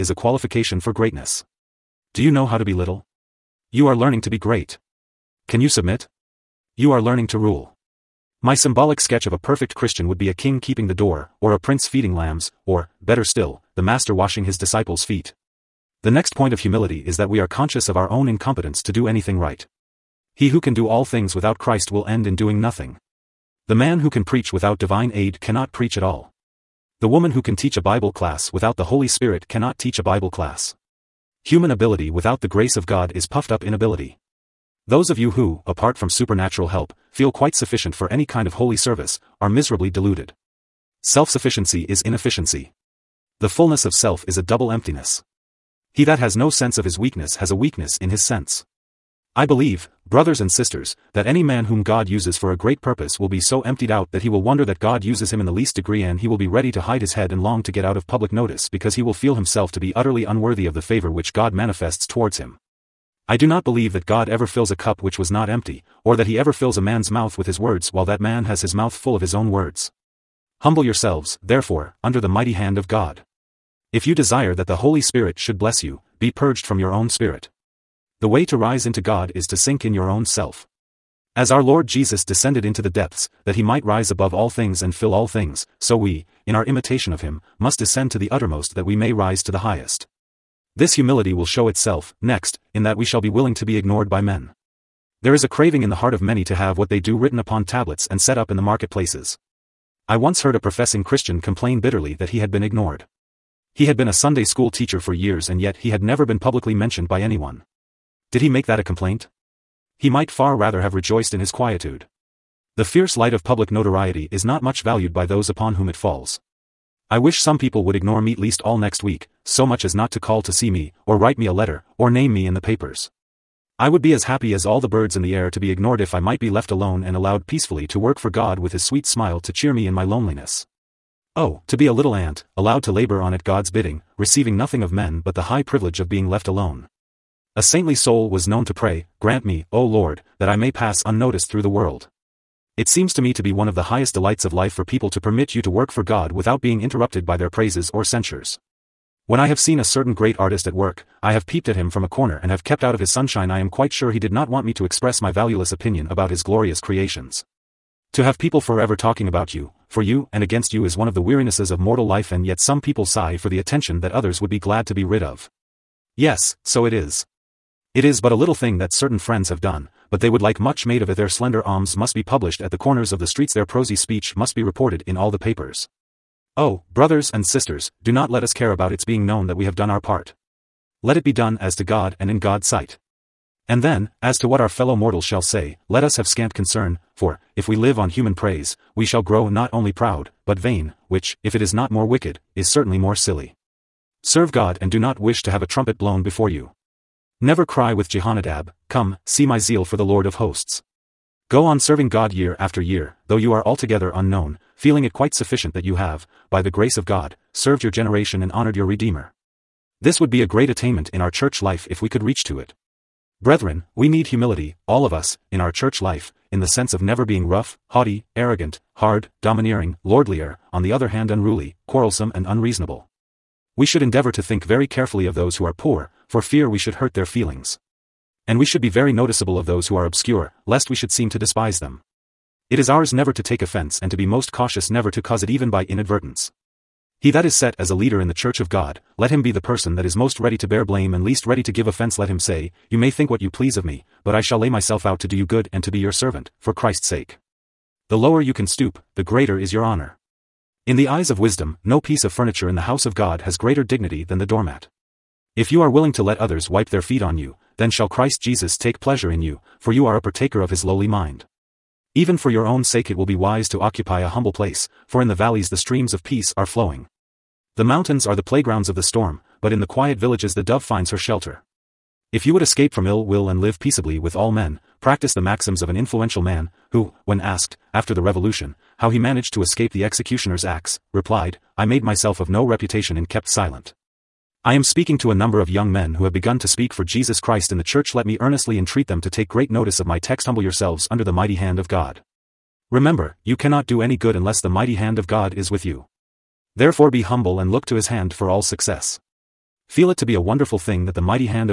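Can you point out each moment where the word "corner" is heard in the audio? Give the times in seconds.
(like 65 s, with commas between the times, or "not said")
152 s, 172 s.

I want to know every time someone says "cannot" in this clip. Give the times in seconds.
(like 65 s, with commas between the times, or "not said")
25 s, 29 s, 293 s.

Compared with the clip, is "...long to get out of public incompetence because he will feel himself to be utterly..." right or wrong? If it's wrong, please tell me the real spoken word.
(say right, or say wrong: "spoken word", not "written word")
wrong: "notice", not "incompetence".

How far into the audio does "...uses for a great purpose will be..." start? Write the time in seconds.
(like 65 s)
52 s.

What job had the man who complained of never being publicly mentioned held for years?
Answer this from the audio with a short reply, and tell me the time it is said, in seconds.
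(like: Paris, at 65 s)
Sunday school teacher, at 104 s.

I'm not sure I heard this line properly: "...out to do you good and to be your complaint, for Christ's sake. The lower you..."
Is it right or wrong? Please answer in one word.
wrong.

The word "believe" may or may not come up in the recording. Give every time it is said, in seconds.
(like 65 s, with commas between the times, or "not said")
49 s, 63 s.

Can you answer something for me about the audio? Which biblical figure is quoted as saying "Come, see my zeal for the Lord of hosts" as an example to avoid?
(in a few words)
Jehonadab.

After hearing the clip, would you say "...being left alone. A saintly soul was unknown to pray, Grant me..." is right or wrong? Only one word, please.
wrong.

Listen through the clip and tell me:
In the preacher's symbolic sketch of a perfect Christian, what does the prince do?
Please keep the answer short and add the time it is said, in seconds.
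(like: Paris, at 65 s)
Feeding lambs, at 11 s.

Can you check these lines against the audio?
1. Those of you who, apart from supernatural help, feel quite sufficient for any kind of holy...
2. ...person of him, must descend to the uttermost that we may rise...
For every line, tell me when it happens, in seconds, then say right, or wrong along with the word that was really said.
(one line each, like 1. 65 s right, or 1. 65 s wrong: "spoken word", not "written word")
1. 34 s right
2. 86 s wrong: "imitation", not "person".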